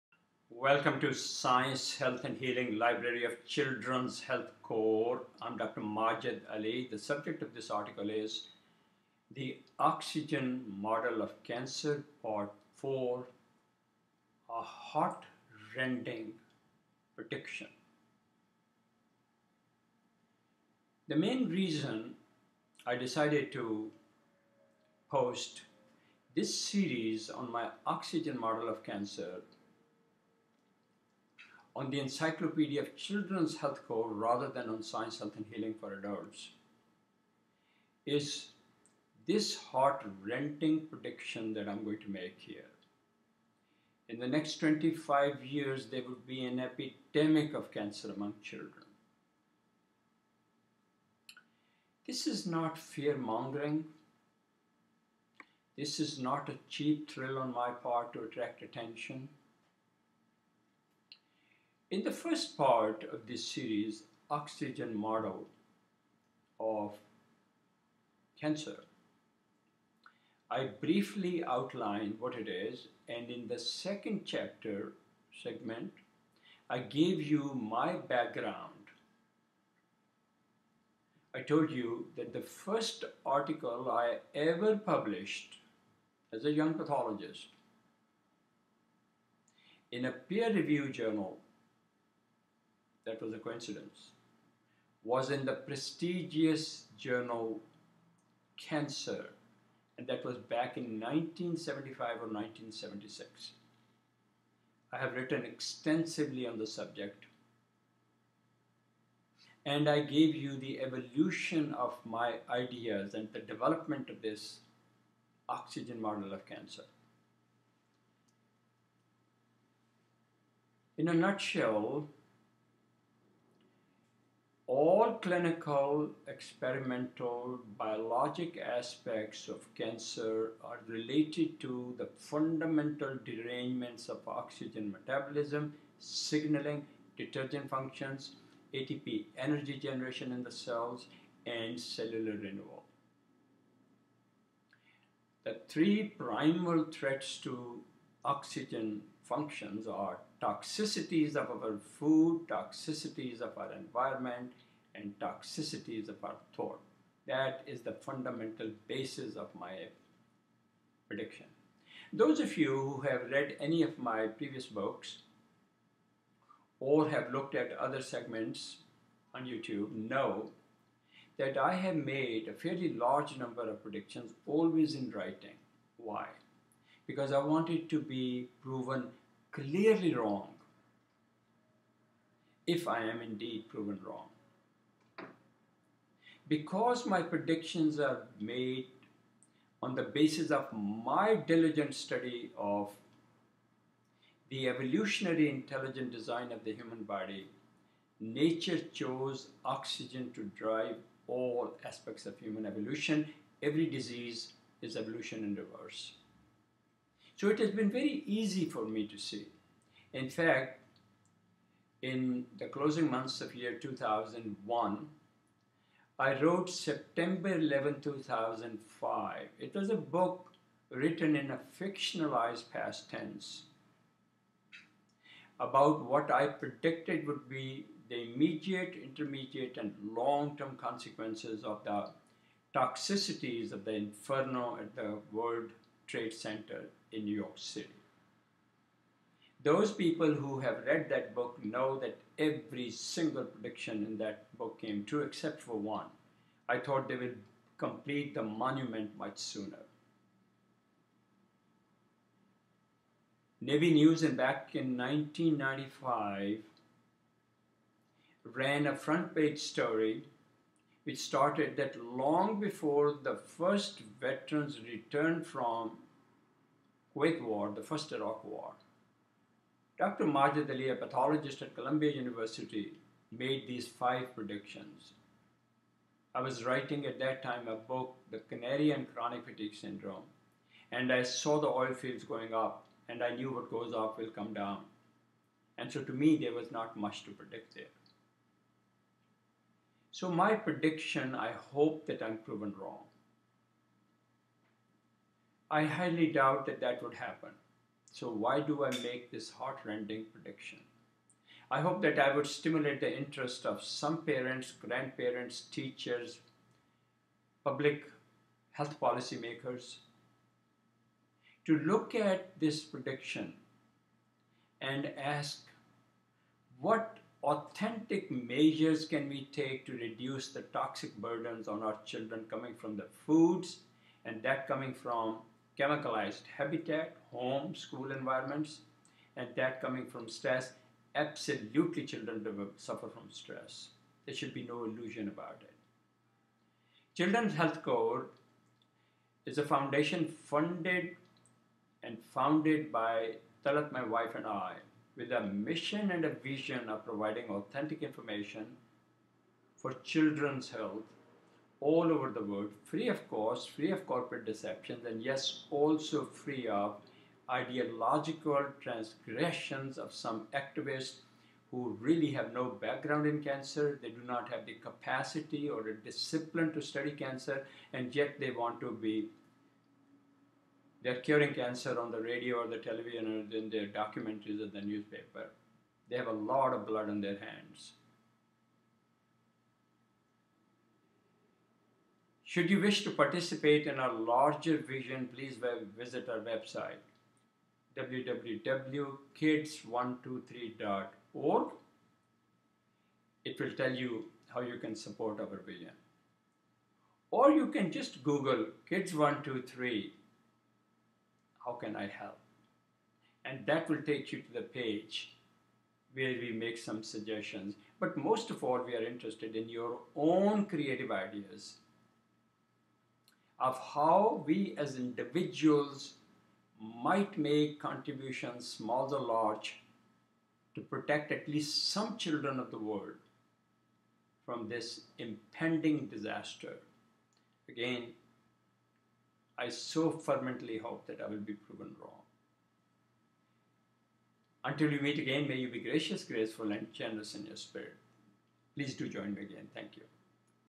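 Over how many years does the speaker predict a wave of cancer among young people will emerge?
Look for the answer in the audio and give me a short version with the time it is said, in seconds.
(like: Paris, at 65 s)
25 years, at 44 s.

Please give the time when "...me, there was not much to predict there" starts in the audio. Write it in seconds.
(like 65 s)
286 s.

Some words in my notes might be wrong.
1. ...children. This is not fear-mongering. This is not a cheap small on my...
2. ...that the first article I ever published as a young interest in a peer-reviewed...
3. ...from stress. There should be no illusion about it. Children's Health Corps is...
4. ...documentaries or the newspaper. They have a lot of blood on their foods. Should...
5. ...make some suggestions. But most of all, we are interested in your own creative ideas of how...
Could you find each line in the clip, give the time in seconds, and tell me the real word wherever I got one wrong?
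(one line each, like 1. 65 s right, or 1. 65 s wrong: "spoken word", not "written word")
1. 48 s wrong: "thrill", not "small"
2. 82 s wrong: "pathologist", not "interest"
3. 333 s right
4. 373 s wrong: "hands", not "foods"
5. 406 s right.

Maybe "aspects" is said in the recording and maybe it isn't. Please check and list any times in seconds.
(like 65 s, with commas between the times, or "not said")
128 s, 201 s.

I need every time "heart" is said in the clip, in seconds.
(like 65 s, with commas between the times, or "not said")
14 s, 39 s, 299 s.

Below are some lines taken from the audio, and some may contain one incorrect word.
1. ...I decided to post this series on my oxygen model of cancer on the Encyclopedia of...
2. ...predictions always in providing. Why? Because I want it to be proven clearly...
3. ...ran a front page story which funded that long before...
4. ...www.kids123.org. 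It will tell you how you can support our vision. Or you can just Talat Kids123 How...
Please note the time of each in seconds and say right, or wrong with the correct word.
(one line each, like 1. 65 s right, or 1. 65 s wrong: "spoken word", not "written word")
1. 22 s right
2. 173 s wrong: "writing", not "providing"
3. 258 s wrong: "started", not "funded"
4. 387 s wrong: "Google", not "Talat".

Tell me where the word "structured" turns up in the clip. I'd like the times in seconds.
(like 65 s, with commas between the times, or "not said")
not said.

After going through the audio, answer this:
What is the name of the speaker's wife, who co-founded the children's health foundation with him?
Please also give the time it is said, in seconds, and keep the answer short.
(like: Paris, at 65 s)
Talat, at 343 s.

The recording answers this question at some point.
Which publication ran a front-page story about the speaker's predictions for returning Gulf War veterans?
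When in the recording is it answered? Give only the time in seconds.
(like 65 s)
253 s.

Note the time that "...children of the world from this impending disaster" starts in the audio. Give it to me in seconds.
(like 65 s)
422 s.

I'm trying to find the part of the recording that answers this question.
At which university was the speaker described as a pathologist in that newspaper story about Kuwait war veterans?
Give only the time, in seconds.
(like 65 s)
271 s.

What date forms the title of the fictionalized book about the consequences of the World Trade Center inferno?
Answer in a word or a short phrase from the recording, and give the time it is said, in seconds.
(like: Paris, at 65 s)
September 11, 2005, at 216 s.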